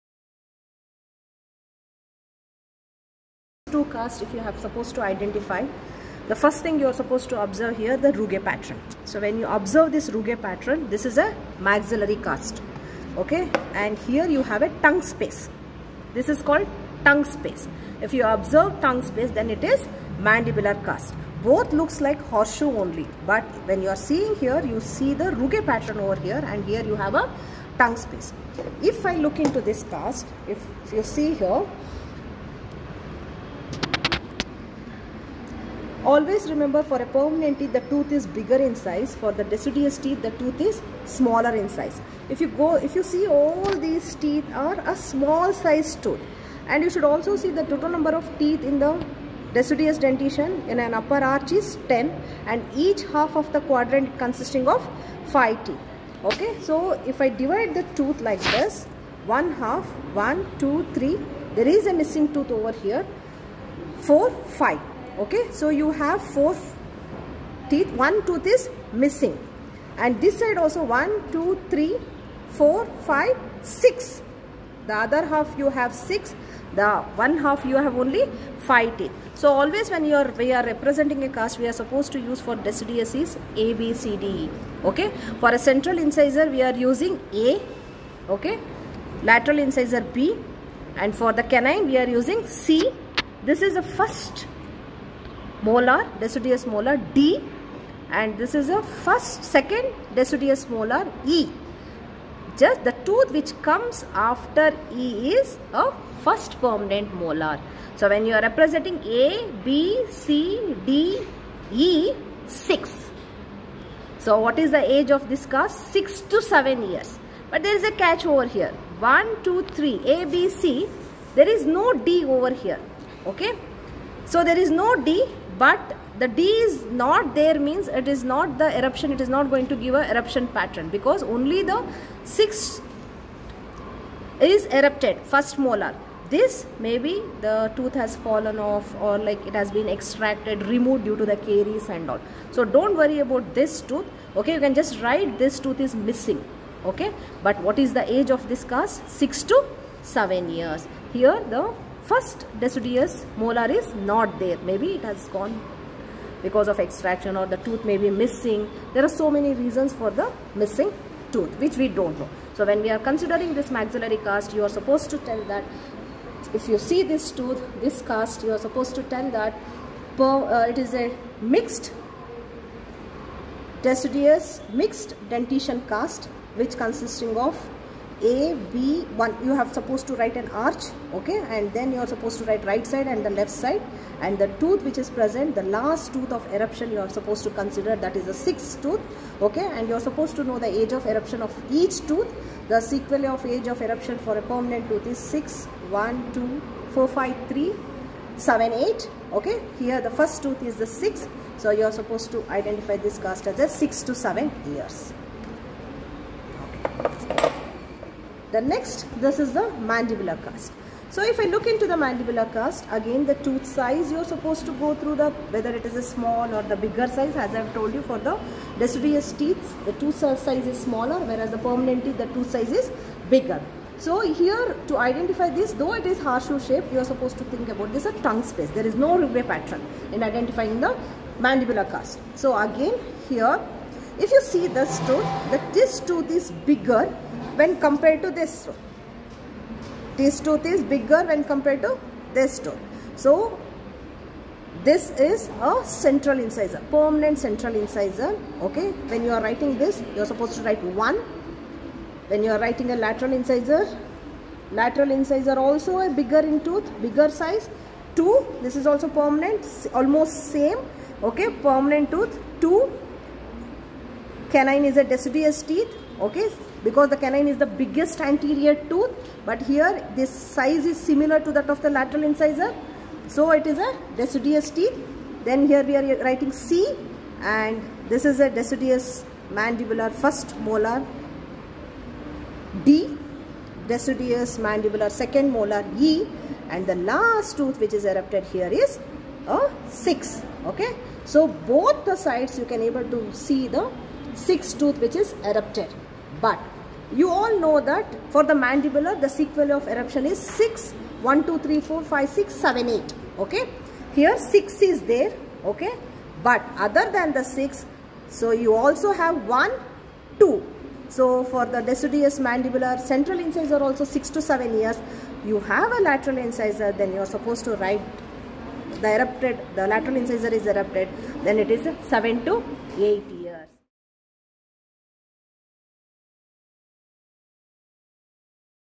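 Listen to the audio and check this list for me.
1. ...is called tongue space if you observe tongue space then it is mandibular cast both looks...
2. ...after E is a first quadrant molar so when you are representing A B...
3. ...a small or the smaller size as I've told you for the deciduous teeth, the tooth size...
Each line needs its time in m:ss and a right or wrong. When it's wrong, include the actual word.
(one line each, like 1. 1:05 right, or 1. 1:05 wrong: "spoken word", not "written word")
1. 0:16 right
2. 1:44 wrong: "permanent", not "quadrant"
3. 3:35 wrong: "bigger", not "smaller".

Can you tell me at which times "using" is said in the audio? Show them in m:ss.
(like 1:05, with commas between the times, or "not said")
1:26, 1:32.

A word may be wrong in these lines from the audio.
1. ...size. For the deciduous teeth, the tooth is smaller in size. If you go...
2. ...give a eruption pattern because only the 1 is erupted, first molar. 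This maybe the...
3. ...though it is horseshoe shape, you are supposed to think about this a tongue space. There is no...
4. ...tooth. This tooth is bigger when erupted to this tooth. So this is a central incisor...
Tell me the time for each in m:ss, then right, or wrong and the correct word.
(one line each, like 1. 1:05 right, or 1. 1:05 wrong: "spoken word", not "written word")
1. 0:38 right
2. 2:09 wrong: "6", not "1"
3. 3:45 right
4. 3:58 wrong: "compared", not "erupted".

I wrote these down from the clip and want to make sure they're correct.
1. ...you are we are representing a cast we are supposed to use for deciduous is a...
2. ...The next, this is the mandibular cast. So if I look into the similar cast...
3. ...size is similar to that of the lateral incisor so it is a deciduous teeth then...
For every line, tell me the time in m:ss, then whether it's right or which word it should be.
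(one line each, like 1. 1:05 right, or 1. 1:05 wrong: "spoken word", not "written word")
1. 1:20 right
2. 3:28 wrong: "mandibular", not "similar"
3. 4:30 right.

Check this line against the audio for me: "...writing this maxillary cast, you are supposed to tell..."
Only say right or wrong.
wrong.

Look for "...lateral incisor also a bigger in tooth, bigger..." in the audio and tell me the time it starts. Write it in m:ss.
4:14.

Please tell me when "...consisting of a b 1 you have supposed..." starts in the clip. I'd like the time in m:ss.
2:56.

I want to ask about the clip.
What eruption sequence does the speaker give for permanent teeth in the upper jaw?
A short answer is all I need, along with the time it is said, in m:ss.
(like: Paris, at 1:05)
6 1 2 4 5 3 7 8, at 3:15.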